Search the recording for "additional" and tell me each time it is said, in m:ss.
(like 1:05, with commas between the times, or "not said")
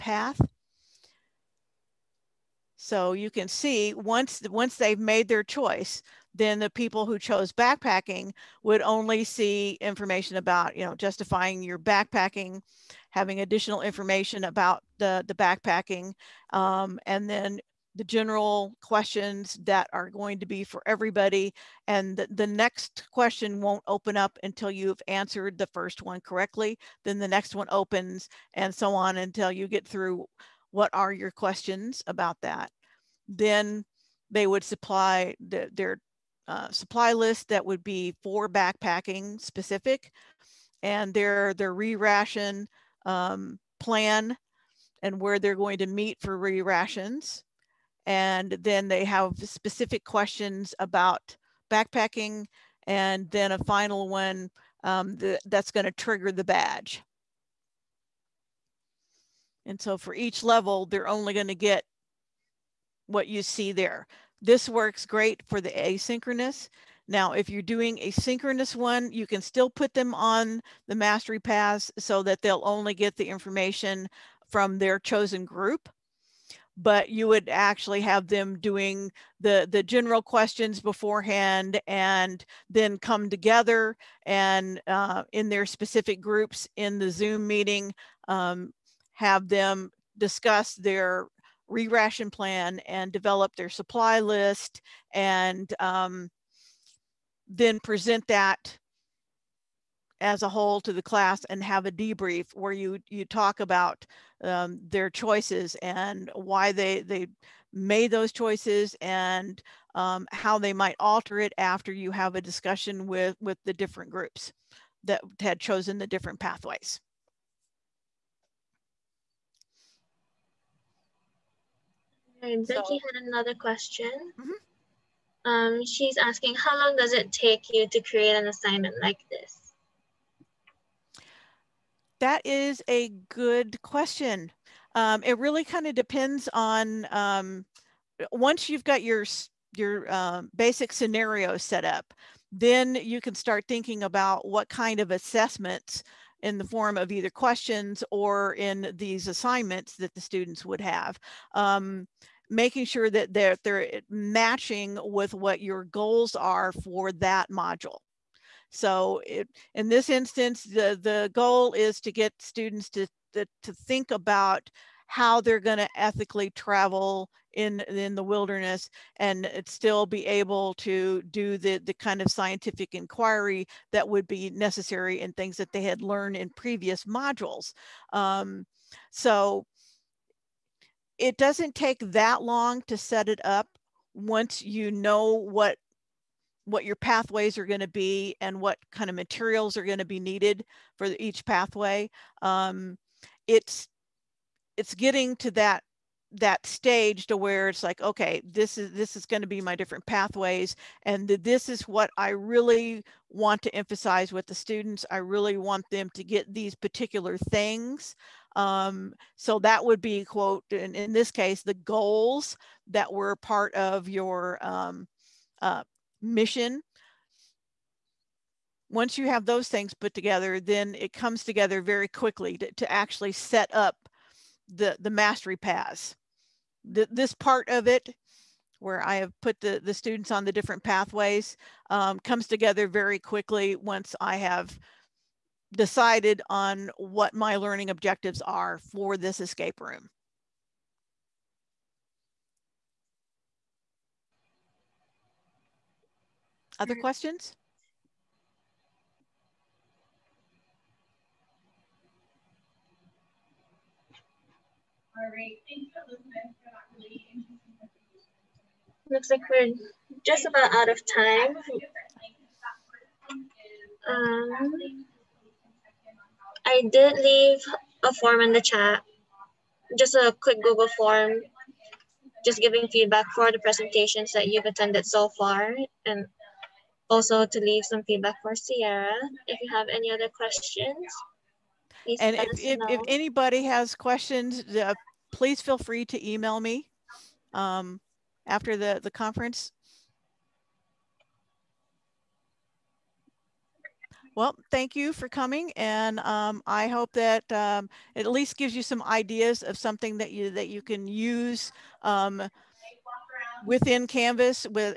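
0:13.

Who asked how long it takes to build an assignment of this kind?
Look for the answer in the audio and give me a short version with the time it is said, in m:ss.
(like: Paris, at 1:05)
Becky, at 2:02.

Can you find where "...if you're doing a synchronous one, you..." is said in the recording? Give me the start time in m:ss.
1:07.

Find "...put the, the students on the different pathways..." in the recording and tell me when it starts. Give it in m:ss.
3:49.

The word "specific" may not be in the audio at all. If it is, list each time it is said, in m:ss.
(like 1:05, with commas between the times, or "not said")
0:39, 0:49, 1:25.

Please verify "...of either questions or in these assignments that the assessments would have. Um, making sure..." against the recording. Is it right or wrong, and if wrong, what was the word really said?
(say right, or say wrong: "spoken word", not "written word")
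wrong: "students", not "assessments".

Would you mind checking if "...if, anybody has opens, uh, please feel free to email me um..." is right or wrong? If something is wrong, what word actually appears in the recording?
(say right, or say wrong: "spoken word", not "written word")
wrong: "questions", not "opens".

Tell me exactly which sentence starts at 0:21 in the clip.
And the, the, next question won't open up until you've answered the first one correctly.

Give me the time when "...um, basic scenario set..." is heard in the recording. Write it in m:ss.
2:20.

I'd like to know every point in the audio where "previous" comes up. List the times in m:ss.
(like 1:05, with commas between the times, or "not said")
2:56.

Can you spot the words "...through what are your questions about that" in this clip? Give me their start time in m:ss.
0:29.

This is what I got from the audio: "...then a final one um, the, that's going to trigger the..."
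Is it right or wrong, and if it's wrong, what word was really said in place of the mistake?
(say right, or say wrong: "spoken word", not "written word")
right.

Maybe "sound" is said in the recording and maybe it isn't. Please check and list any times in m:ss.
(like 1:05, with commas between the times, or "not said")
not said.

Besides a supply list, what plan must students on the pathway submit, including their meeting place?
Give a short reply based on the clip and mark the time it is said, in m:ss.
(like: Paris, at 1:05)
re-ration plan, at 0:41.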